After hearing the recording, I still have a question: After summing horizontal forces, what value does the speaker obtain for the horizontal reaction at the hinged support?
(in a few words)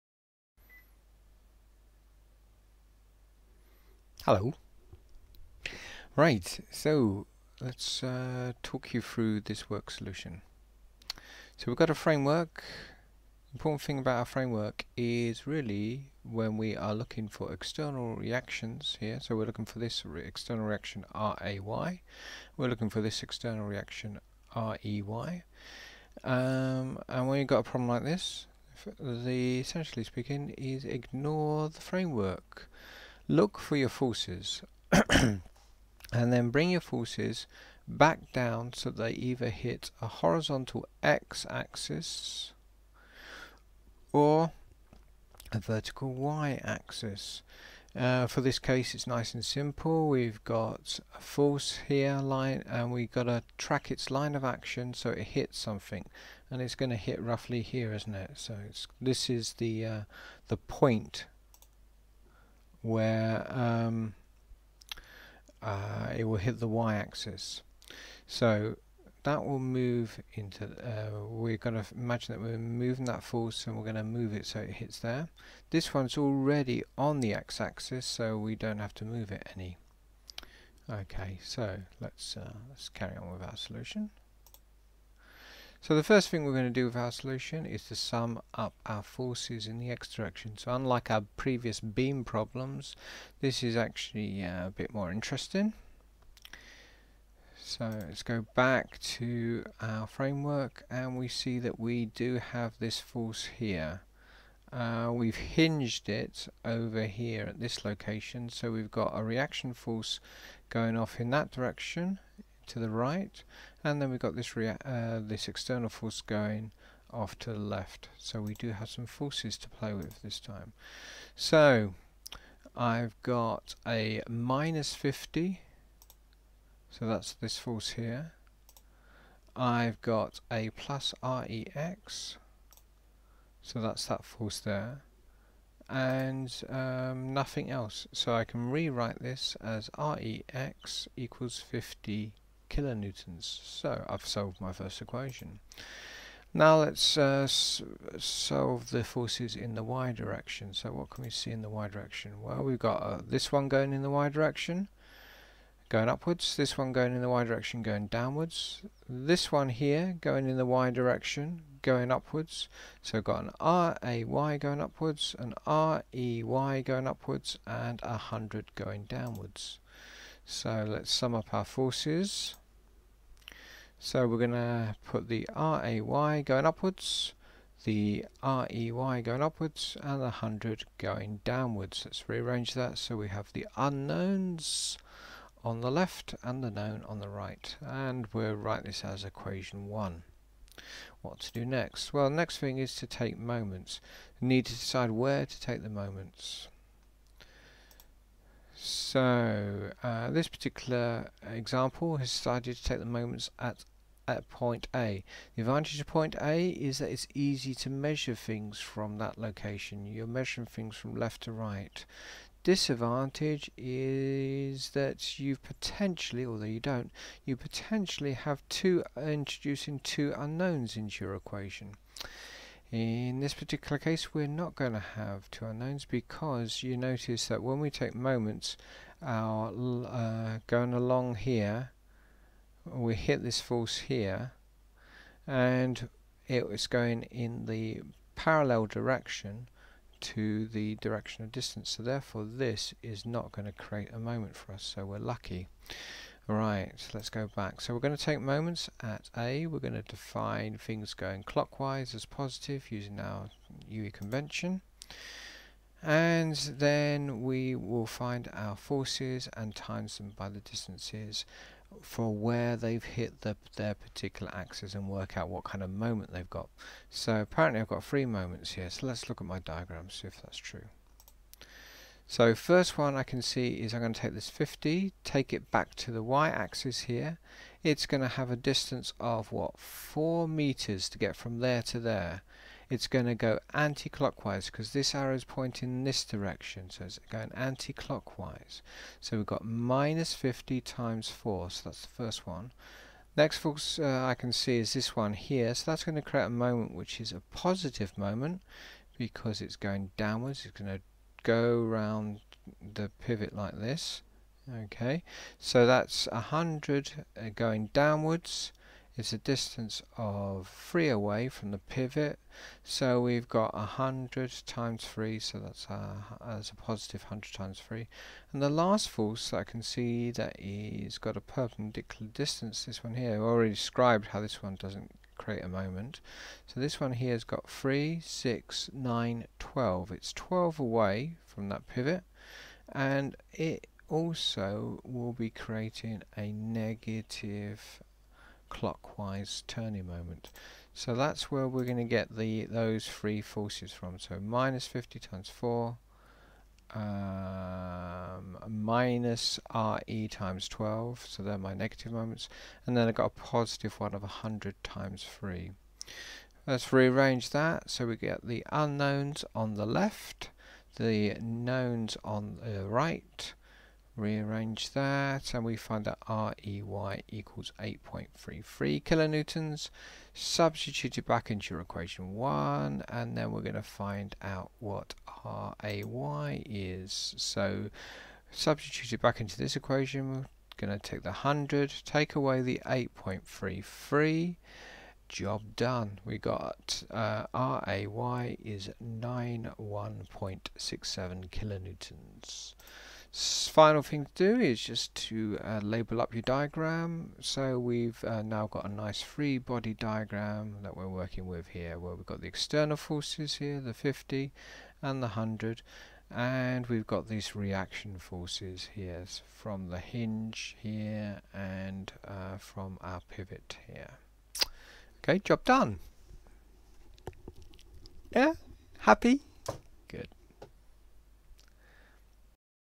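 50 kilonewtons.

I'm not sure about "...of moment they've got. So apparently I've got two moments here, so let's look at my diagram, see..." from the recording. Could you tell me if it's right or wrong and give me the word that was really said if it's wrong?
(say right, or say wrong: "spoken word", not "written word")
wrong: "three", not "two".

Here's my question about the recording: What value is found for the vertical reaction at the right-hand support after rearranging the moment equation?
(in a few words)
8.33 kilonewtons.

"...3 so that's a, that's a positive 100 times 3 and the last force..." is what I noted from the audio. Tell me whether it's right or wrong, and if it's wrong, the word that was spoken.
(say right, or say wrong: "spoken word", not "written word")
right.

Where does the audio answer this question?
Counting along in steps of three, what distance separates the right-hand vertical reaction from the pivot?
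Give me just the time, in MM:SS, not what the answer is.
05:30.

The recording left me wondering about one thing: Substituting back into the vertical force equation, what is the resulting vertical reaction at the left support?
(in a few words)
91.67 kilonewtons.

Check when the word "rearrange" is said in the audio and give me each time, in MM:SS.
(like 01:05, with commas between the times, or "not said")
03:02, 05:56, 06:04.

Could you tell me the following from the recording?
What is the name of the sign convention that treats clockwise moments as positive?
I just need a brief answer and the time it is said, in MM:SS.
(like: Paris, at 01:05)
UE convention, at 04:13.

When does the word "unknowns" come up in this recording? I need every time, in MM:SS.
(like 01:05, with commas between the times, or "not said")
03:03, 03:40, 03:45, 05:58.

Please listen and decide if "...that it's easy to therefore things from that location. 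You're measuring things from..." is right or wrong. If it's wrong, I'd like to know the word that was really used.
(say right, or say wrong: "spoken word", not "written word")
wrong: "measure", not "therefore".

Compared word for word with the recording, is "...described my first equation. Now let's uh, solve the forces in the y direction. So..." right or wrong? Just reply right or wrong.
wrong.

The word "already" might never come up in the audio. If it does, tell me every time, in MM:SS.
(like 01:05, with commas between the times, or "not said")
01:16, 05:23.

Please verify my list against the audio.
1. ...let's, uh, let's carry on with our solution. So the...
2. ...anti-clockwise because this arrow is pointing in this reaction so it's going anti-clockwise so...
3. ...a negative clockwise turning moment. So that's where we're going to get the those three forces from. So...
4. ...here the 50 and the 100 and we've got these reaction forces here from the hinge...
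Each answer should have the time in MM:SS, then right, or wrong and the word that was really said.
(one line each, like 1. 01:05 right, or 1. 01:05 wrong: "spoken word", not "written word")
1. 01:21 right
2. 04:43 wrong: "direction", not "reaction"
3. 05:36 right
4. 06:43 right.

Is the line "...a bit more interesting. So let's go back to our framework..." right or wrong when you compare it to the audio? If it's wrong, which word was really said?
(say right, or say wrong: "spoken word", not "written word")
right.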